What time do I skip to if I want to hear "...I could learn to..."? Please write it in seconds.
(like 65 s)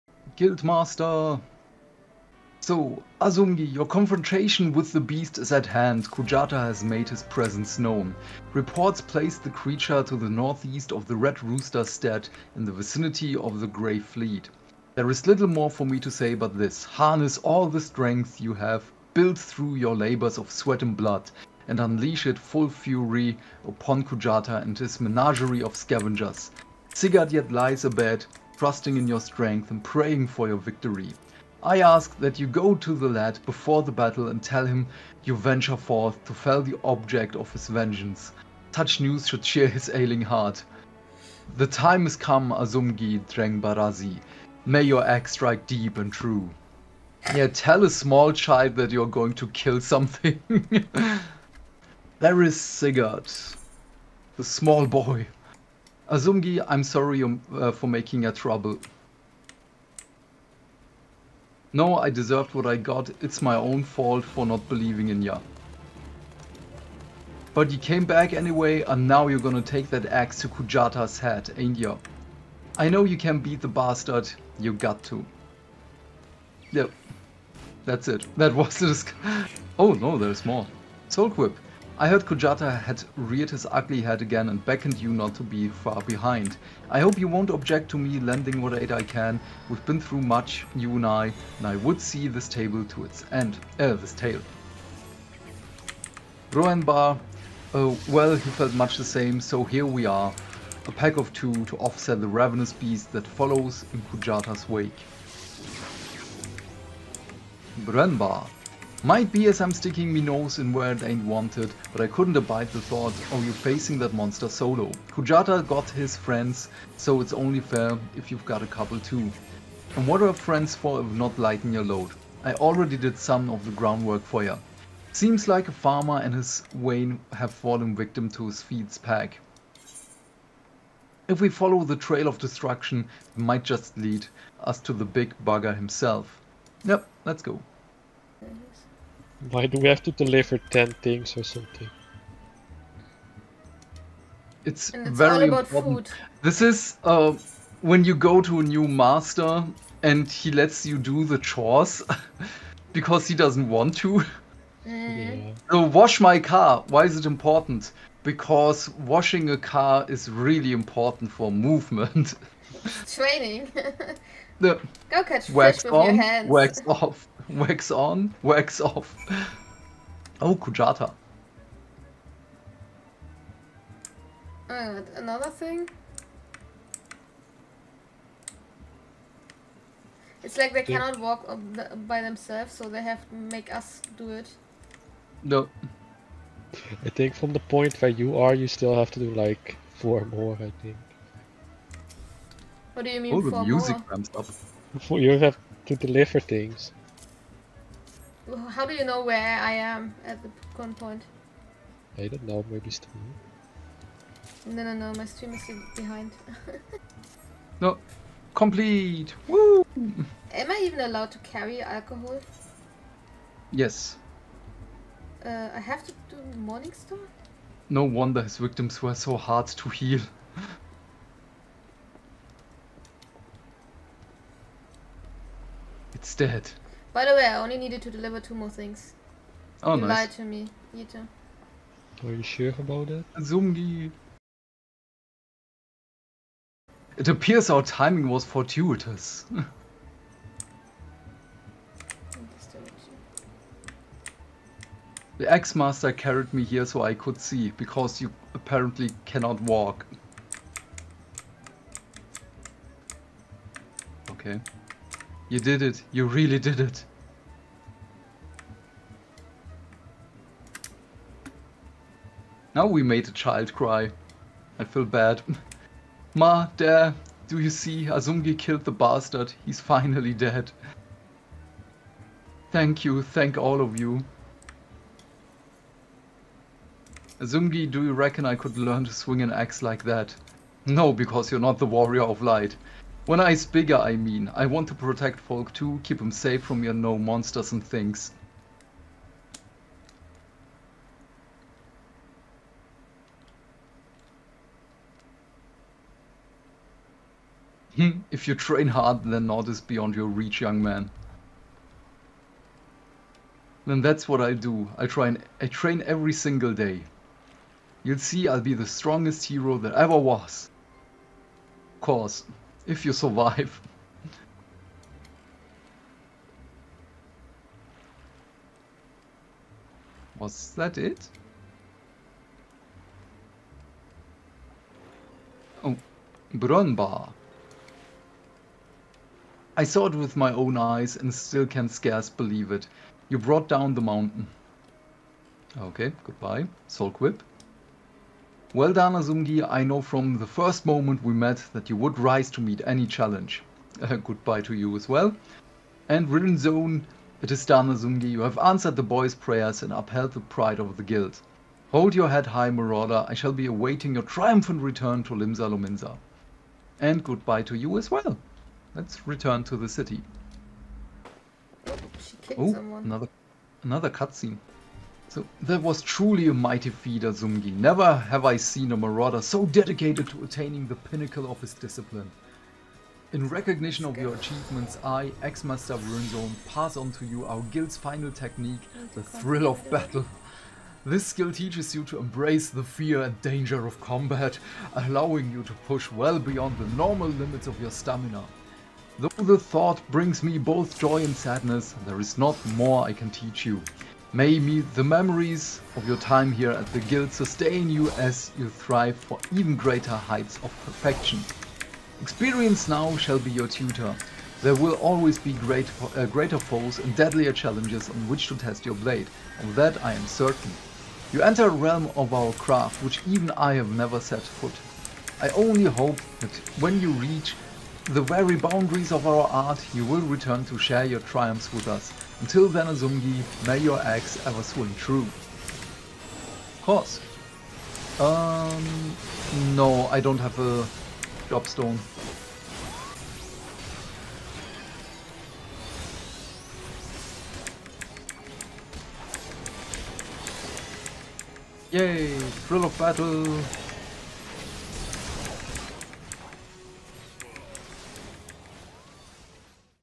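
278 s.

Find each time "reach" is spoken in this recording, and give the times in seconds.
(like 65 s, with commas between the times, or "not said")
300 s, 417 s.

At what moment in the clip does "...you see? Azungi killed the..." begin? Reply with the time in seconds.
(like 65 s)
267 s.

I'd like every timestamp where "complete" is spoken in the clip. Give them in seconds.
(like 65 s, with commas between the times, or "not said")
208 s.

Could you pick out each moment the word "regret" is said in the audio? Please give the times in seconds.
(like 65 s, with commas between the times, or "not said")
not said.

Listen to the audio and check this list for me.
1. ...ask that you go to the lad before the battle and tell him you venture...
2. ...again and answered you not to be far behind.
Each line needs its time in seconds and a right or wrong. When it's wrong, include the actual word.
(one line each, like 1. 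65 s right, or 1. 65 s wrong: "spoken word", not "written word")
1. 31 s right
2. 84 s wrong: "beckoned", not "answered".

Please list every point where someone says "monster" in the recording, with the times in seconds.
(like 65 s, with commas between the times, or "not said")
114 s, 287 s.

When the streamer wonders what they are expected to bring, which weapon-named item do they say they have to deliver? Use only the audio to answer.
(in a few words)
Morning star.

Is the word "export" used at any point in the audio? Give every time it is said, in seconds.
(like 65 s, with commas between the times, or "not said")
not said.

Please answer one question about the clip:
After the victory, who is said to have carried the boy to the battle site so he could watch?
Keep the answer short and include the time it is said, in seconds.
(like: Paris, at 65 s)
The Axe-Master, at 245 s.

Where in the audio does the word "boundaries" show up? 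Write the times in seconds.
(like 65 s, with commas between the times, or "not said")
418 s.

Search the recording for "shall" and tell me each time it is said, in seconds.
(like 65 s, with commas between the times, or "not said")
353 s, 403 s.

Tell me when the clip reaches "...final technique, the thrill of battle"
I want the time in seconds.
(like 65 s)
377 s.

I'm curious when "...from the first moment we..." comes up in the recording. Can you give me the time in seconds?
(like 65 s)
340 s.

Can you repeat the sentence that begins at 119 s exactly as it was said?
And what are friends for if not lighten your load?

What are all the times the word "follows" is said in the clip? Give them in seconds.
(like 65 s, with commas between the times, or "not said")
103 s, 131 s.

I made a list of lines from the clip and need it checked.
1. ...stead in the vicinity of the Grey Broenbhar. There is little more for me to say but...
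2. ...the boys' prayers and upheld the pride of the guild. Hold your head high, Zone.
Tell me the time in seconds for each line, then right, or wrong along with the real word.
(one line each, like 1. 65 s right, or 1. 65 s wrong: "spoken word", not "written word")
1. 11 s wrong: "Fleet", not "Broenbhar"
2. 348 s wrong: "Marauder", not "Zone".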